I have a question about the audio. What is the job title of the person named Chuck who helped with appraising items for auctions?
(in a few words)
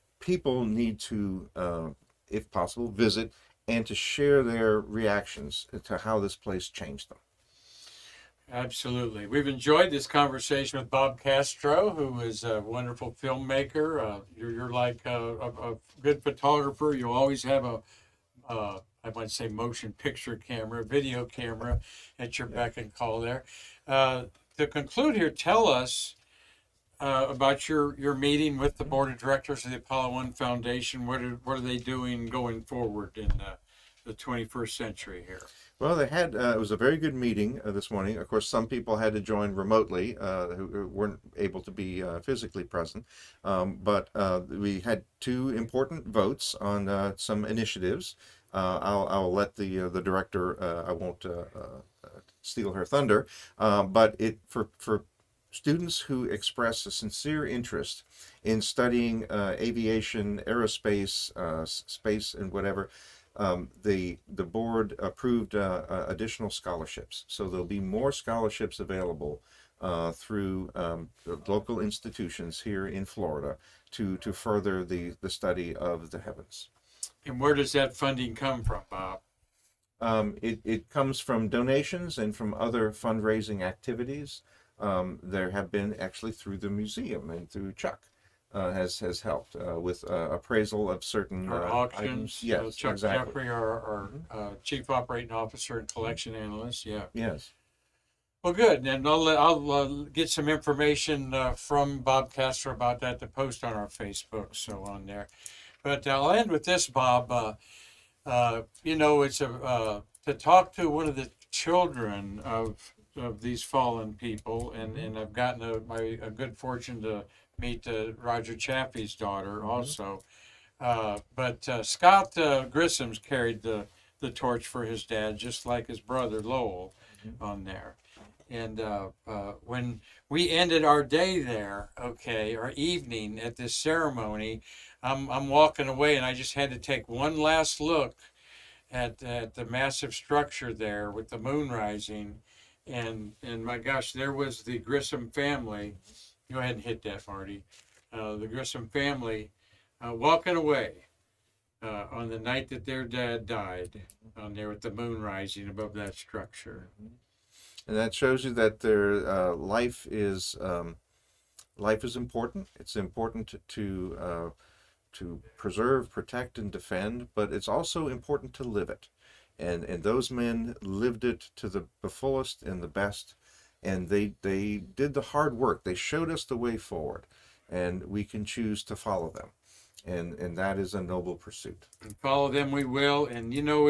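Chief operating officer.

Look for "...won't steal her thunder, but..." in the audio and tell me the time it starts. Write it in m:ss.
0:50.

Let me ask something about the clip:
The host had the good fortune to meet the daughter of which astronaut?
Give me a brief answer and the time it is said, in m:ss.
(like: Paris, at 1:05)
Roger Chaffee, at 1:58.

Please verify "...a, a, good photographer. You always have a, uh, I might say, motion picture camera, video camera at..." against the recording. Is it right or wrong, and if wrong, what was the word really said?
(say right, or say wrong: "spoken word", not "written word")
right.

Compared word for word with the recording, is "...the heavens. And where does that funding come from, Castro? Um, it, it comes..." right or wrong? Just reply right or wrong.
wrong.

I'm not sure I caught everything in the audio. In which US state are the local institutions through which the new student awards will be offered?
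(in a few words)
Florida.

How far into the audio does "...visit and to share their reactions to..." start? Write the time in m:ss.
0:02.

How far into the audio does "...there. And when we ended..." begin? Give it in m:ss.
2:07.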